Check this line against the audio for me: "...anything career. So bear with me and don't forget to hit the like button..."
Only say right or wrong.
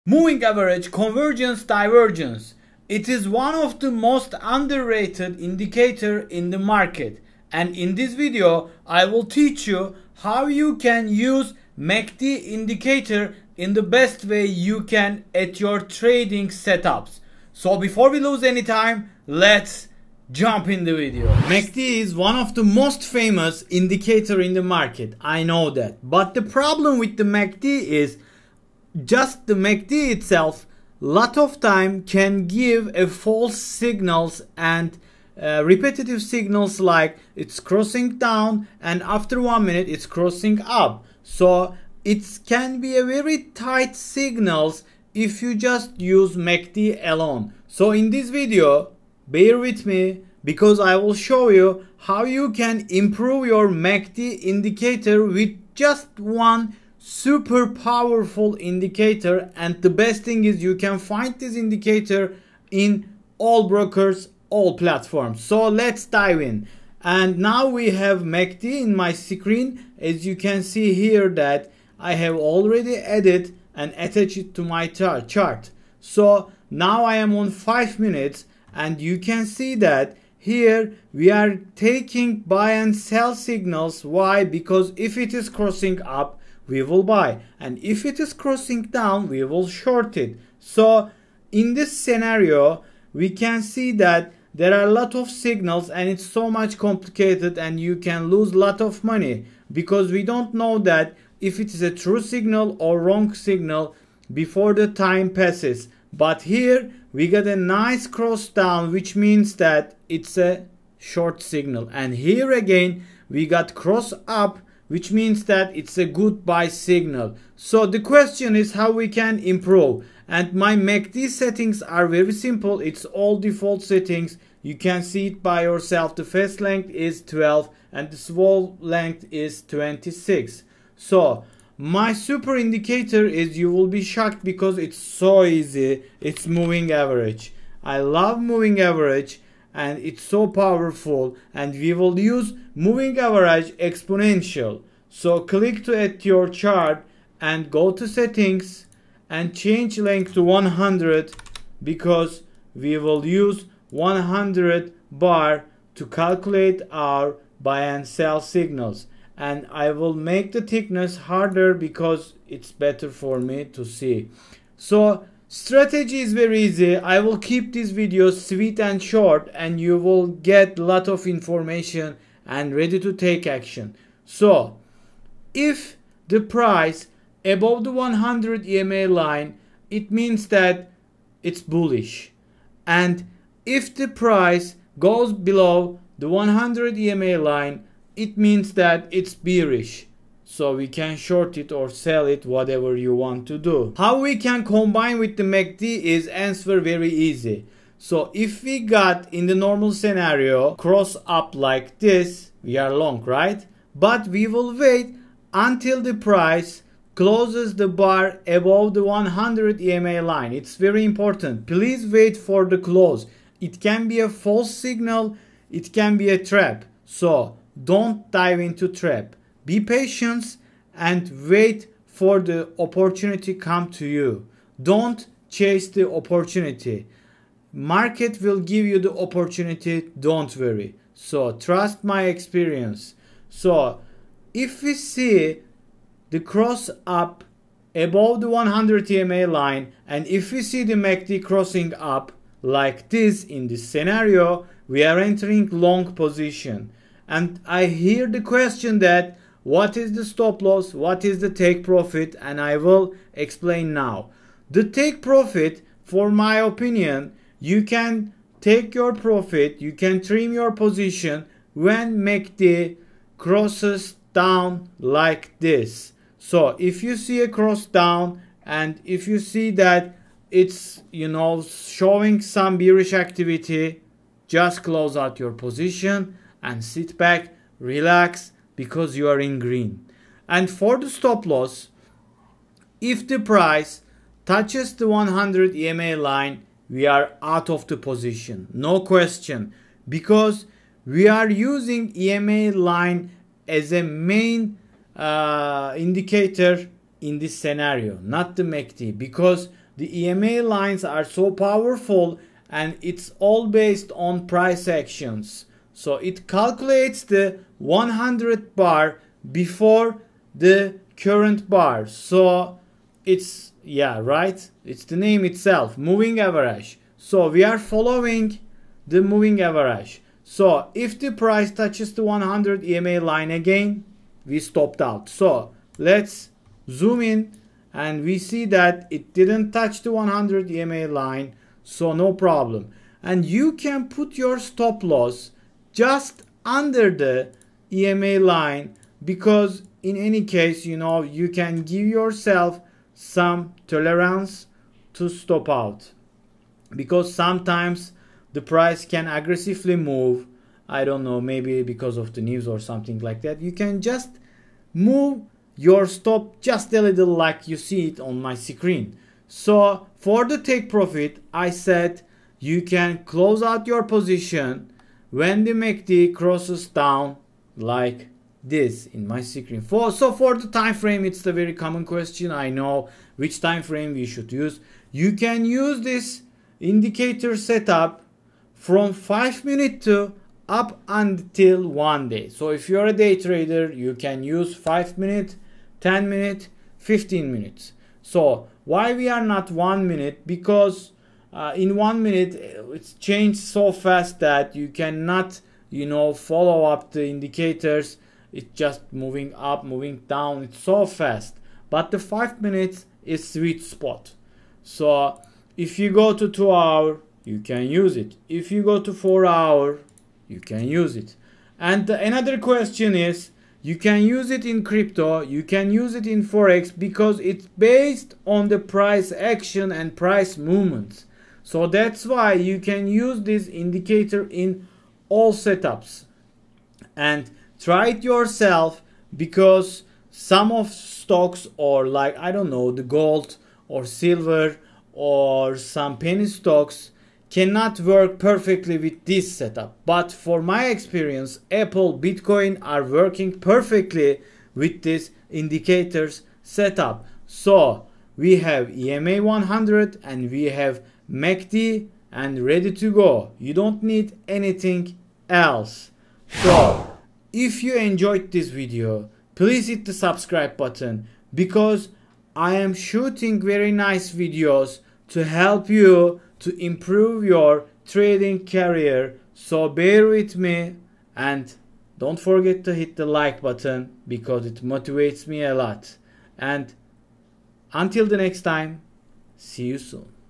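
wrong.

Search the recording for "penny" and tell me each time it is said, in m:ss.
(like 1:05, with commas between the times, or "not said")
7:16.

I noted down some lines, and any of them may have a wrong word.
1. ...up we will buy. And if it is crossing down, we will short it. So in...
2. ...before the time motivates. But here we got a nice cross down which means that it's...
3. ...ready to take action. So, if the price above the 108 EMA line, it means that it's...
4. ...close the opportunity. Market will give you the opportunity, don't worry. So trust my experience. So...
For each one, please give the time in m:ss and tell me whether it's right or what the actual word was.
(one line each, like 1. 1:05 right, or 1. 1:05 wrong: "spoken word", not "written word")
1. 1:26 right
2. 1:44 wrong: "passes", not "motivates"
3. 2:52 wrong: "100", not "108"
4. 3:45 wrong: "chase", not "close".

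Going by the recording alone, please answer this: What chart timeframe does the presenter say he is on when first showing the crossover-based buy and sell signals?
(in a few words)
5 minutes.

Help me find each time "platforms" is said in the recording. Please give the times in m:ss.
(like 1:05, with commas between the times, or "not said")
1:04.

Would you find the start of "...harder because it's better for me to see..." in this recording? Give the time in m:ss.
2:41.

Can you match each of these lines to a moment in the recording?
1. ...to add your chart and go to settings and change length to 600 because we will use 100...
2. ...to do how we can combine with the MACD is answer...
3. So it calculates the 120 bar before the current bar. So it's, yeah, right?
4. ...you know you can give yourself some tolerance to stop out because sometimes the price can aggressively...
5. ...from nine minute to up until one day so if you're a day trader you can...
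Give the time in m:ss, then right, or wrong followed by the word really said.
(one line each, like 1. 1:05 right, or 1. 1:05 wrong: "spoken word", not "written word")
1. 2:25 wrong: "100", not "600"
2. 3:13 right
3. 5:06 wrong: "100", not "120"
4. 5:40 right
5. 6:18 wrong: "five", not "nine".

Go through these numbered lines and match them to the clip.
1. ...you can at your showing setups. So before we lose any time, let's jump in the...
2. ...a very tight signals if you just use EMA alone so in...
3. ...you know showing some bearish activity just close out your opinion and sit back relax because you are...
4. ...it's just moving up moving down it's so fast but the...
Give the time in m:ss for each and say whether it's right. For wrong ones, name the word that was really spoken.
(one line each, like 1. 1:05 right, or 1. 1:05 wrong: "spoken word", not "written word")
1. 0:14 wrong: "trading", not "showing"
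2. 0:42 wrong: "MACD", not "EMA"
3. 4:31 wrong: "position", not "opinion"
4. 6:38 right.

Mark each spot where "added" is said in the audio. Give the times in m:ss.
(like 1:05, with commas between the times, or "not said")
1:12.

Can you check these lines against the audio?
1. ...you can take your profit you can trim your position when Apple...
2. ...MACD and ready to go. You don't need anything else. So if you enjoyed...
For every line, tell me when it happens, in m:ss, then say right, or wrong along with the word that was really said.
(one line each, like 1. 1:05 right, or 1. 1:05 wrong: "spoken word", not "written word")
1. 4:17 wrong: "MACD", not "Apple"
2. 7:31 right.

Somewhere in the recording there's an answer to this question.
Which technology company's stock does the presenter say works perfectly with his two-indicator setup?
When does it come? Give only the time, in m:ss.
7:21.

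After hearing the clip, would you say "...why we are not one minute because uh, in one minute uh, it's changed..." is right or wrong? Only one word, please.
right.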